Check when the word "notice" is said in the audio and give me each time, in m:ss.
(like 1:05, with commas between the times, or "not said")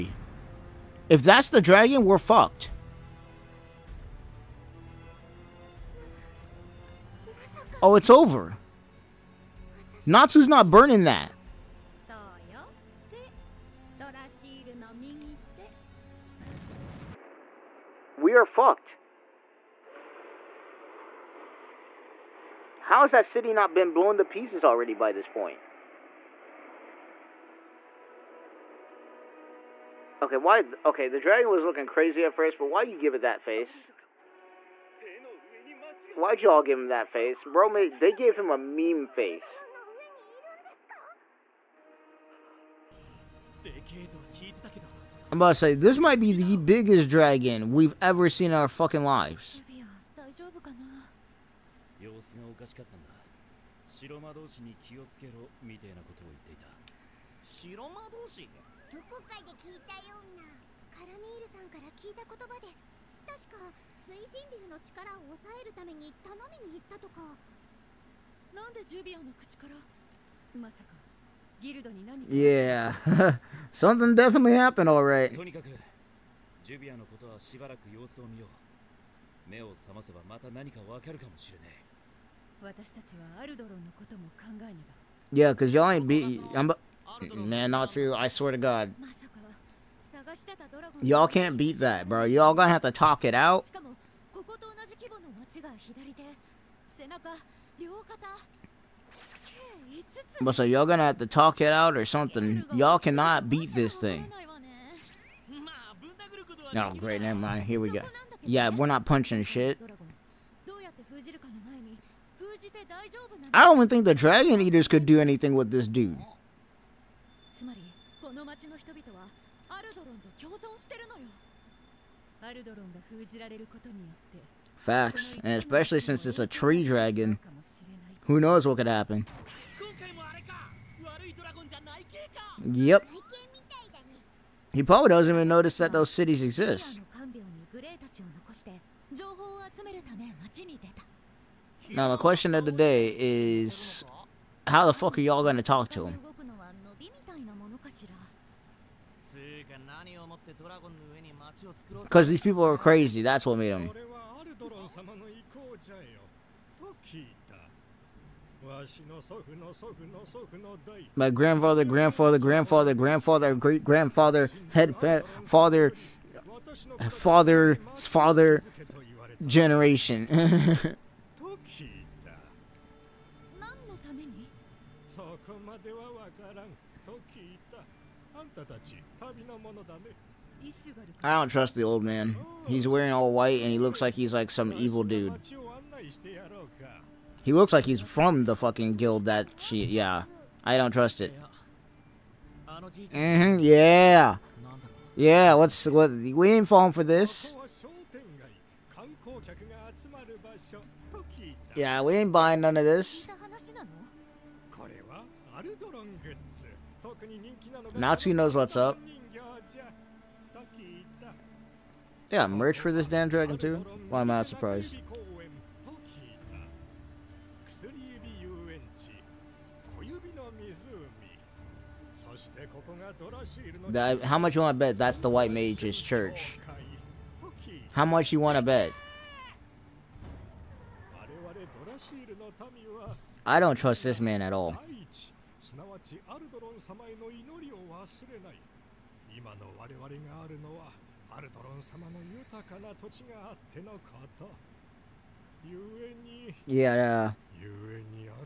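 2:15.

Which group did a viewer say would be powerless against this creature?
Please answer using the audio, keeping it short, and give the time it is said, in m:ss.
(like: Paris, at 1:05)
The Dragon Eaters, at 1:54.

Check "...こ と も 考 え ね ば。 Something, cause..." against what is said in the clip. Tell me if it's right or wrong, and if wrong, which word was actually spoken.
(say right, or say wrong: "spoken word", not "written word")
wrong: "Yeah", not "Something".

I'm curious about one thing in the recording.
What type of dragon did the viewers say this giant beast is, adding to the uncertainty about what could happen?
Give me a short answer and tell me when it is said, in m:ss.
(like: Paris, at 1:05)
Tree dragon, at 2:06.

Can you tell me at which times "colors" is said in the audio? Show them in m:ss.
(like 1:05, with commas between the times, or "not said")
not said.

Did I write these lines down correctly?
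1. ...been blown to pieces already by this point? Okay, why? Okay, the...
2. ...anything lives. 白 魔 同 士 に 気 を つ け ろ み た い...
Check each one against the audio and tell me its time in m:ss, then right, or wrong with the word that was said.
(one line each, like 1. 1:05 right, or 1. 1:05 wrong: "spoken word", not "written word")
1. 0:23 right
2. 0:48 wrong: "fucking", not "anything".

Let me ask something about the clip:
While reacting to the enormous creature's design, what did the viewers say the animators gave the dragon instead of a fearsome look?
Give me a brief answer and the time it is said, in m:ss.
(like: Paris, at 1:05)
A meme face, at 0:38.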